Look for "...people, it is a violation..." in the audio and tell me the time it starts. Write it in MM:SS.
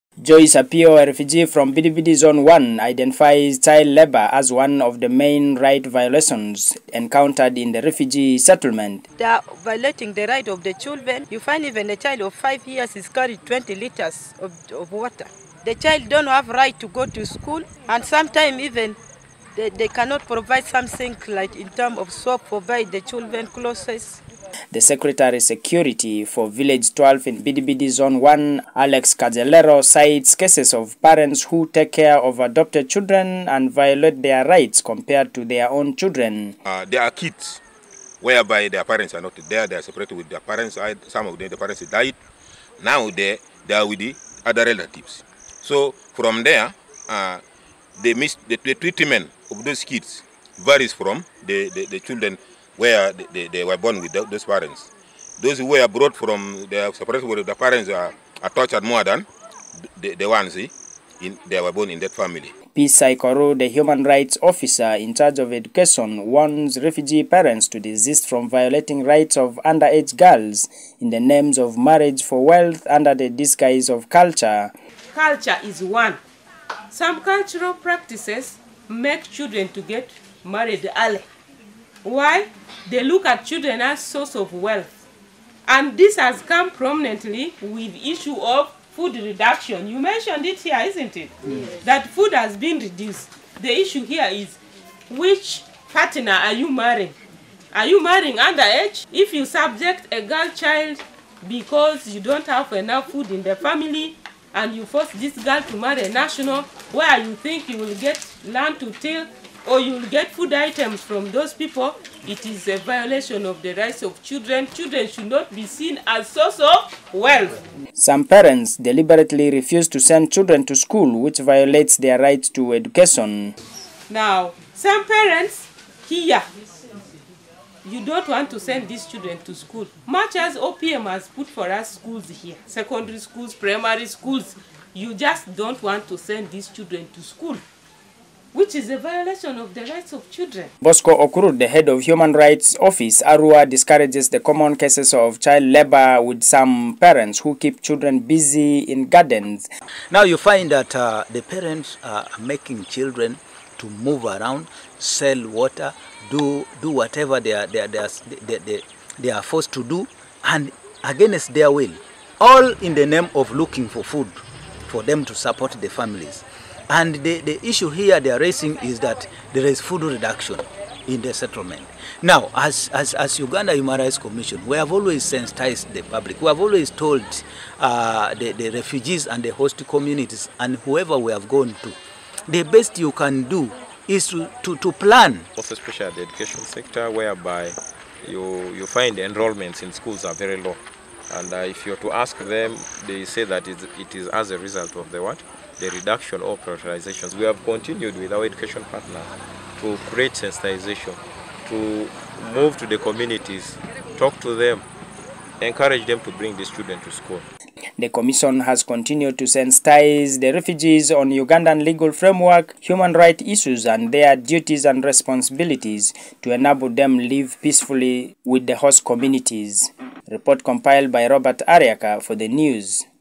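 01:51.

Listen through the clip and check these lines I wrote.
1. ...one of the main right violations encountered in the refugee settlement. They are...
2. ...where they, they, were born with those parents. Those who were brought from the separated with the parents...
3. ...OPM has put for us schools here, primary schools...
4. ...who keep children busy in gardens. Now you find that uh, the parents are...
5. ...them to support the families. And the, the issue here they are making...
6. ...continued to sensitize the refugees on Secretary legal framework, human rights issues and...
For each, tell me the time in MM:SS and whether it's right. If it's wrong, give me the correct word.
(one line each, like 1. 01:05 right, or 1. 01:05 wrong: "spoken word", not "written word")
1. 00:04 right
2. 00:52 right
3. 02:10 wrong: "secondary", not "primary"
4. 02:27 right
5. 02:45 wrong: "raising", not "making"
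6. 03:28 wrong: "Ugandan", not "Secretary".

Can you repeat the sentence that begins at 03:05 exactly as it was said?
Also especially the education sector whereby you, you find enrollments in schools are very low.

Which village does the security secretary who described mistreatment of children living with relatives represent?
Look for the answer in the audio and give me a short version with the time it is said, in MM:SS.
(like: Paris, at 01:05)
Village 12, at 00:26.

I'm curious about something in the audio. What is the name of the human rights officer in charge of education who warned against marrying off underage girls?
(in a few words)
P. Saikoro.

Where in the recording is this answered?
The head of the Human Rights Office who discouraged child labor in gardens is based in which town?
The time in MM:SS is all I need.
02:23.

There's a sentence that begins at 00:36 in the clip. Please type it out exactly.
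Uh, there are kids whereby their parents are not there, they are separated with their parents, some of them, the parents died.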